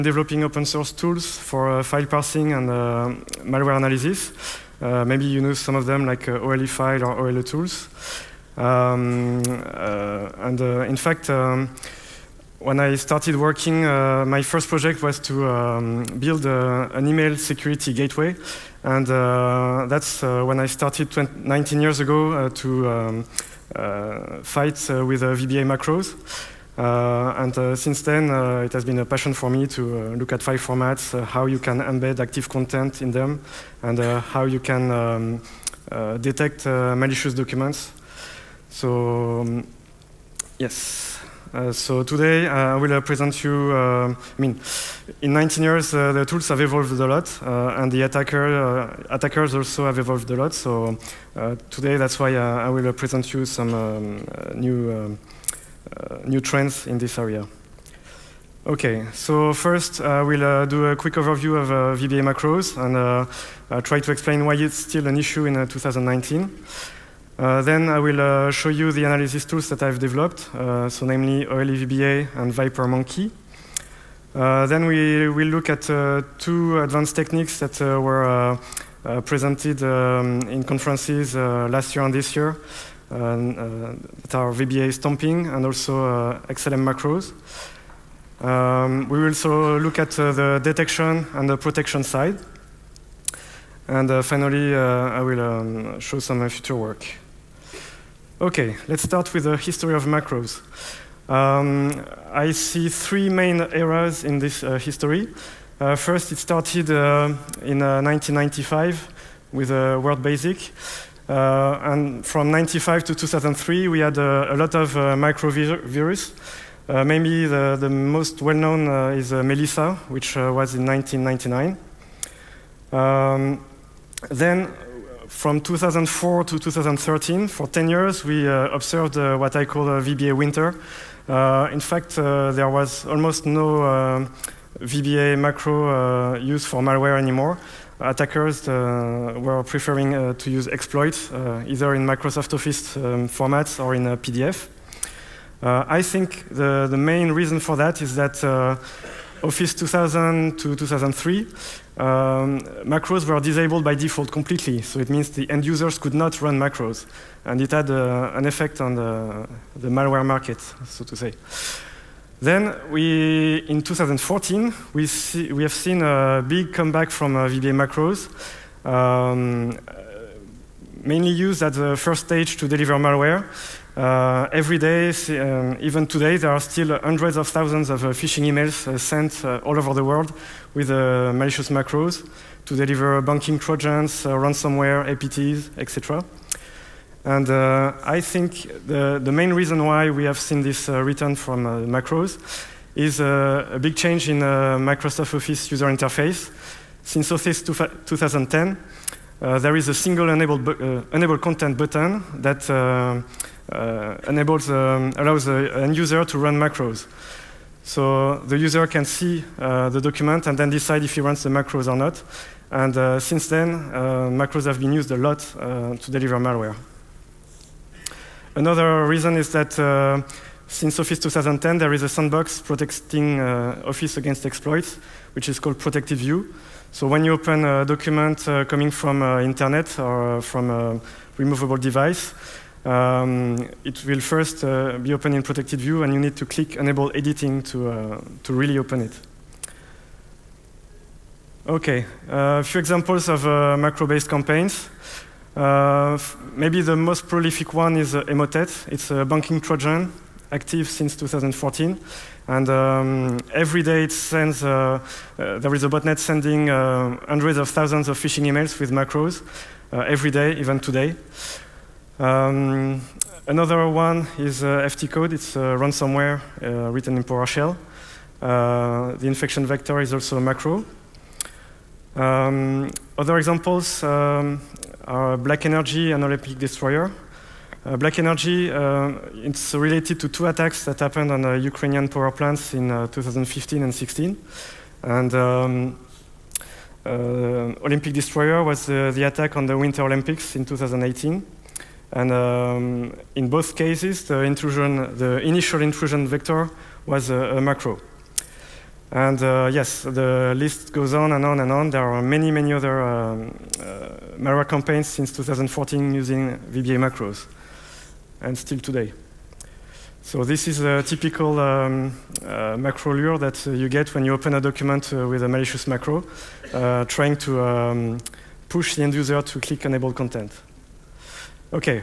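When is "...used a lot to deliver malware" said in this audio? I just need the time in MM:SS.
03:34.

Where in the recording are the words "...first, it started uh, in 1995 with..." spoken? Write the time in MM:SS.
01:45.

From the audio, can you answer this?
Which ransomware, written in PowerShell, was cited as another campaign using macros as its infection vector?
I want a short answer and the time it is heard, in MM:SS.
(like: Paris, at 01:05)
FTCODE, at 04:24.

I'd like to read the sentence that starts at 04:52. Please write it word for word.
And um, in both cases, the intrusion, the initial intrusion vector was a macro.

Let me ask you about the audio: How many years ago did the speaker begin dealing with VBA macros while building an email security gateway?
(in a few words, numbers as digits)
19.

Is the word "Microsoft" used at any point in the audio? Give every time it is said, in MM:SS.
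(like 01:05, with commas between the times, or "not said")
02:22, 03:14.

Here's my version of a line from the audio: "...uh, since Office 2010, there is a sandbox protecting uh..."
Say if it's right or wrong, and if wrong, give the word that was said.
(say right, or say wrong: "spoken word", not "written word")
right.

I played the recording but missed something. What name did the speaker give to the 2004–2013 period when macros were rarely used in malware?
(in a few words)
VBA winter.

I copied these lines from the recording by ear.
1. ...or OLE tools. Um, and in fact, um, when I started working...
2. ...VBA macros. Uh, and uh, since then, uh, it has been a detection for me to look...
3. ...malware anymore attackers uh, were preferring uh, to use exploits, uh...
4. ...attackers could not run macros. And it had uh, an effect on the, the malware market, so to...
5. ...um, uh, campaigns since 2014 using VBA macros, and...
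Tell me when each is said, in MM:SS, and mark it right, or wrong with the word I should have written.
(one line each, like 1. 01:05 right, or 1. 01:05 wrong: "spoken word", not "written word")
1. 00:07 right
2. 00:25 wrong: "passion", not "detection"
3. 02:16 right
4. 02:35 wrong: "users", not "attackers"
5. 05:03 right.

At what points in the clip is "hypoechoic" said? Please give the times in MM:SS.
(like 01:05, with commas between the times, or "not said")
not said.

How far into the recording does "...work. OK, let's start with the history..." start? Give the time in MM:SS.
01:36.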